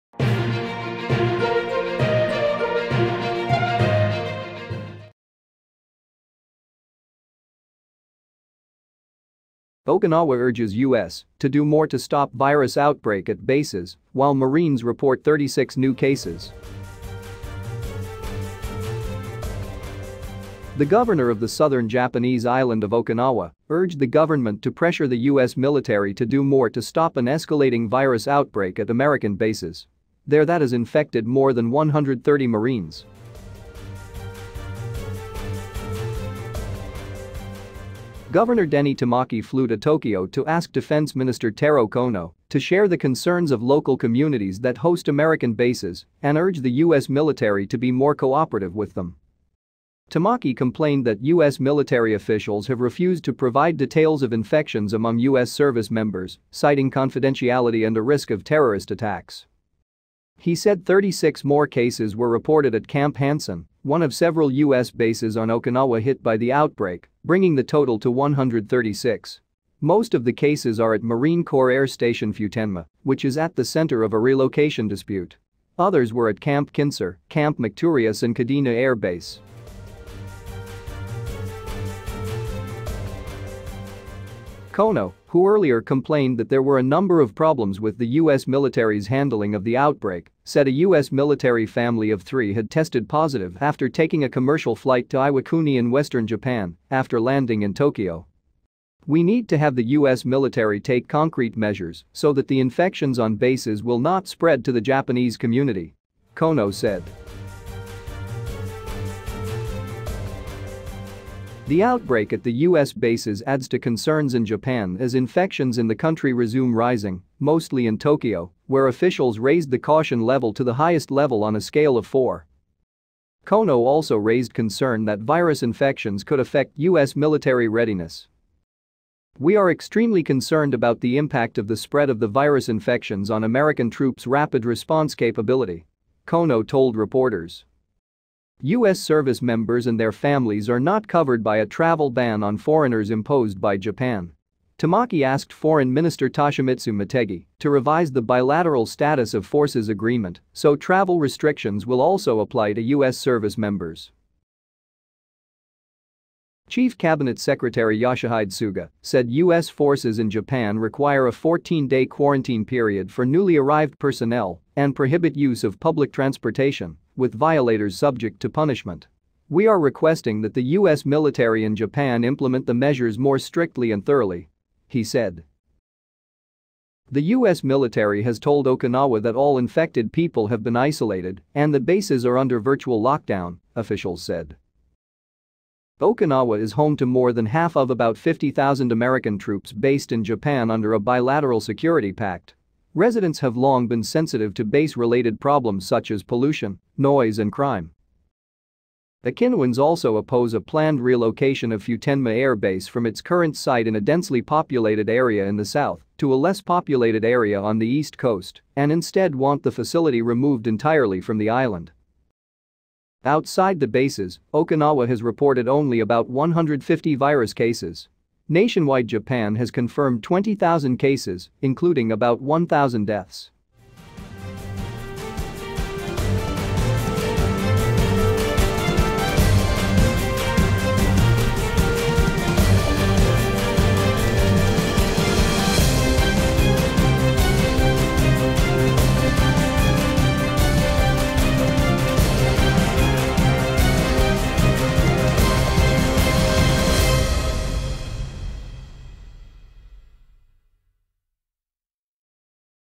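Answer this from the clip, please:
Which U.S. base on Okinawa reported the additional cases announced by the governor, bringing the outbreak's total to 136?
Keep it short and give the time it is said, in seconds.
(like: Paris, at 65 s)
Camp Hansen, at 62 s.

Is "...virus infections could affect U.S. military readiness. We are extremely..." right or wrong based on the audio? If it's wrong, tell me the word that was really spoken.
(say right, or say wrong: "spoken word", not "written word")
right.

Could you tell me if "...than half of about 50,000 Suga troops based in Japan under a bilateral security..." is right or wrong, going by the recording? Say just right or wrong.
wrong.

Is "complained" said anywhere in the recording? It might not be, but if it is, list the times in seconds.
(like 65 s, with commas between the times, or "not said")
50 s, 85 s.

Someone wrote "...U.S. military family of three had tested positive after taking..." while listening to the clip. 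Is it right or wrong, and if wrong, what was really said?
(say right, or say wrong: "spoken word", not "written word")
right.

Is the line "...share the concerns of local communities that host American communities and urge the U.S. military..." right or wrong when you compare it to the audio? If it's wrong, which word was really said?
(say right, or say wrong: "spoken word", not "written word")
wrong: "bases", not "communities".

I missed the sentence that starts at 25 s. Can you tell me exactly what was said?
military to do more to stop an escalating virus outbreak at American bases.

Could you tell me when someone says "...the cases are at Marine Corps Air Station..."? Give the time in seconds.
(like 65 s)
70 s.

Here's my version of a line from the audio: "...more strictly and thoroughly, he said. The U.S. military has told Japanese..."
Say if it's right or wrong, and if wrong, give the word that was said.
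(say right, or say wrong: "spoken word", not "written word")
wrong: "Okinawa", not "Japanese".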